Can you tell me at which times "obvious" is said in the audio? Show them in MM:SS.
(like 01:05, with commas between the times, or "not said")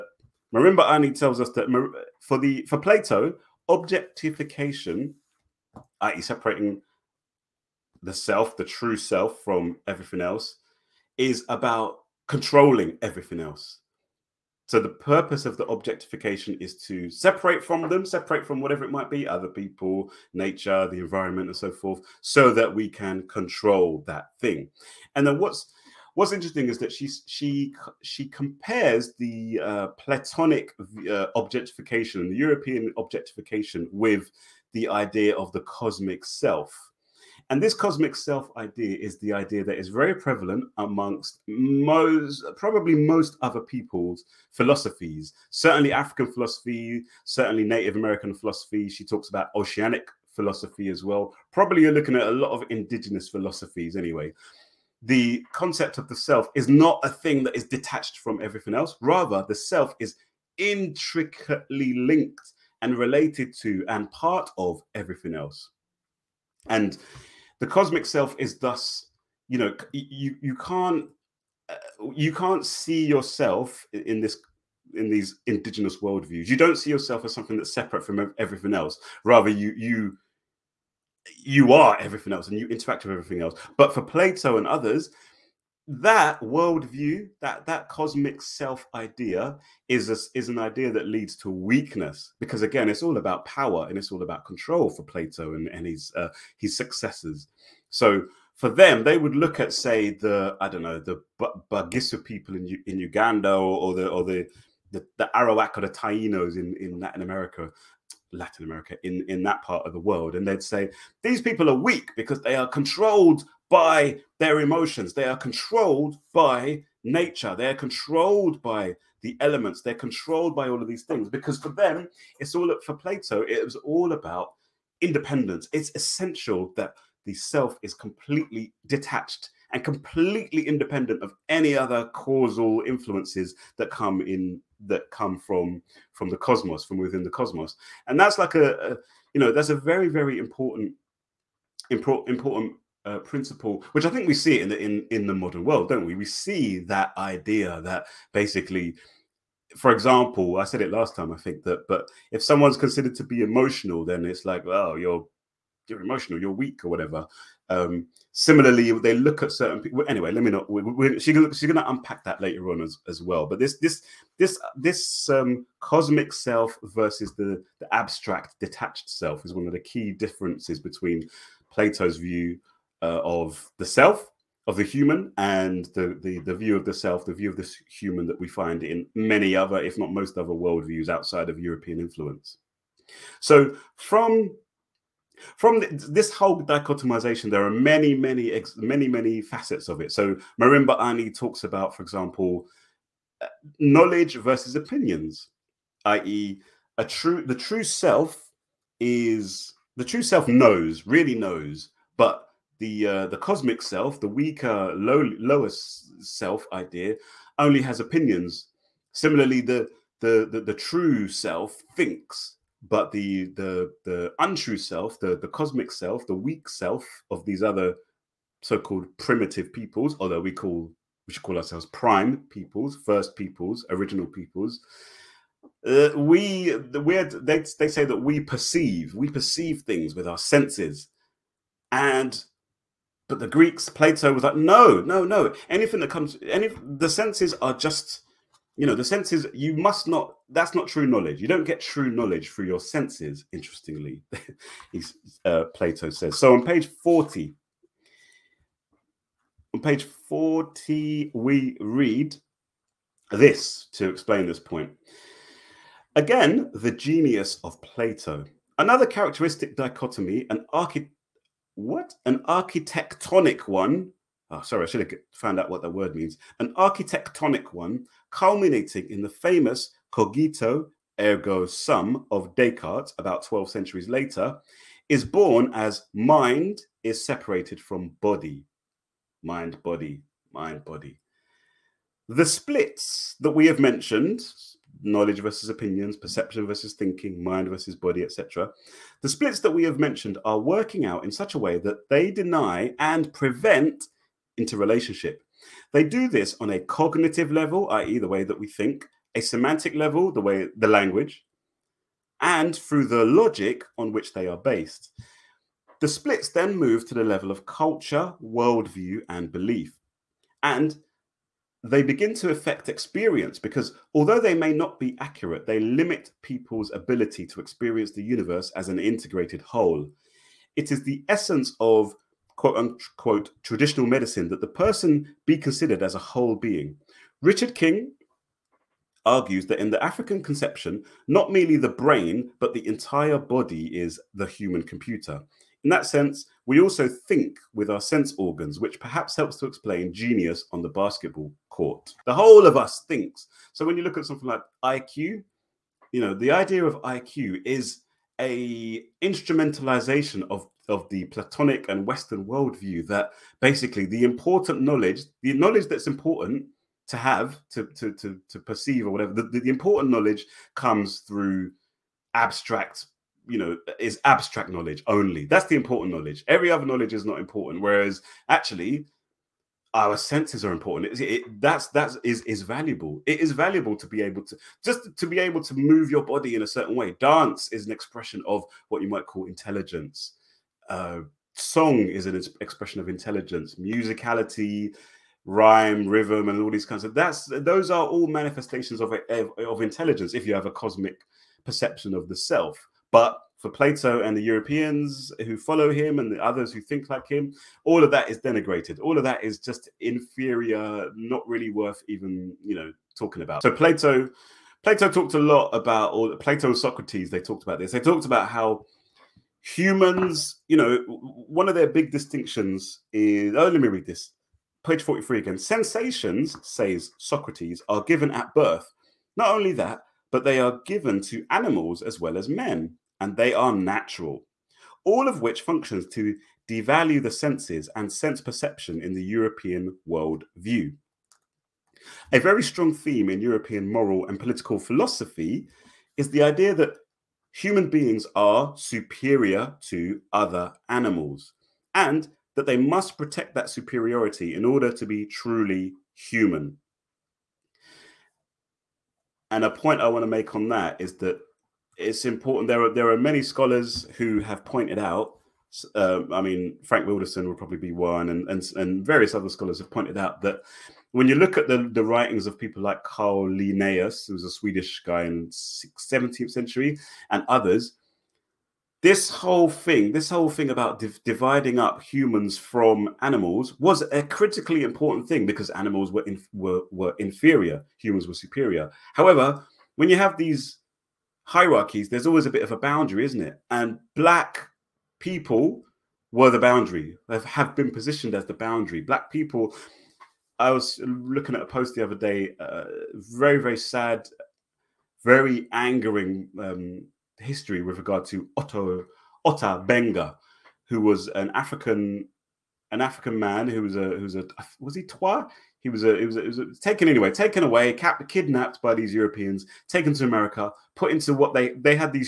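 not said.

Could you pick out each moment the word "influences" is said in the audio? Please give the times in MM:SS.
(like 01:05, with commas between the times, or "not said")
02:12, 03:02.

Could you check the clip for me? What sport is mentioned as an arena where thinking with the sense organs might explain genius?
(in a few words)
Basketball.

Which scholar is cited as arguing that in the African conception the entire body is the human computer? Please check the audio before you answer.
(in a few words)
Richard King.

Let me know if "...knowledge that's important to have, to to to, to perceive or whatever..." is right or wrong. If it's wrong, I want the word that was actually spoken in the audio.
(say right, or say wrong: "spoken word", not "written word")
right.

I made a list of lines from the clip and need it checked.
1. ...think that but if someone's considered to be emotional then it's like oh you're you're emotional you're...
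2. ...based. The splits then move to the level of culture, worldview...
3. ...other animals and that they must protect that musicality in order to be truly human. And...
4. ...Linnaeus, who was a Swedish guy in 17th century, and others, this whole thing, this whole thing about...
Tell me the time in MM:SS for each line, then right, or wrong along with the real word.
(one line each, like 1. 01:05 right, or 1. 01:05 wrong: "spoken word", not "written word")
1. 02:31 right
2. 05:04 right
3. 07:20 wrong: "superiority", not "musicality"
4. 07:43 right.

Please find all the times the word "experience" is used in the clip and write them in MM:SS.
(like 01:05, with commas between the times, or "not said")
05:12, 05:17.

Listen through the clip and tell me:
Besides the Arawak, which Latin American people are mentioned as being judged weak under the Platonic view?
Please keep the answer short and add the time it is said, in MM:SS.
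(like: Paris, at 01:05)
Tainos, at 01:45.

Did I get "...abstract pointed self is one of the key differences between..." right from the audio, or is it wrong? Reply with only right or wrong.
wrong.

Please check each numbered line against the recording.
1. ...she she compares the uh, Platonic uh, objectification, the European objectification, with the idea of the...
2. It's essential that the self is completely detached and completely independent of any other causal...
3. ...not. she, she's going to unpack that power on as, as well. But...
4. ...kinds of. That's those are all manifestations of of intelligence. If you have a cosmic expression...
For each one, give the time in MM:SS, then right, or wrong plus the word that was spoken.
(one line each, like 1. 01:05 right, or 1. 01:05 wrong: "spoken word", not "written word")
1. 00:27 right
2. 02:05 right
3. 02:40 wrong: "later", not "power"
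4. 06:26 wrong: "perception", not "expression".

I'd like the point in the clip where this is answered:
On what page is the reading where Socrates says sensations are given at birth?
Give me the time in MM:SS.
06:55.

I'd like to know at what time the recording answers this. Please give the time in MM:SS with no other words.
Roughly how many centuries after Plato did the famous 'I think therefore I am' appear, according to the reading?
04:33.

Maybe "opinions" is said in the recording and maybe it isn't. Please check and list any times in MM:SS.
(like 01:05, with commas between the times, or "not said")
03:14, 03:28, 04:45.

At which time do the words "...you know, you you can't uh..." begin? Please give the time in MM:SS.
01:09.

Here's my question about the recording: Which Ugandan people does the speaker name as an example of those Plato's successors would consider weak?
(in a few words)
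Bagisu.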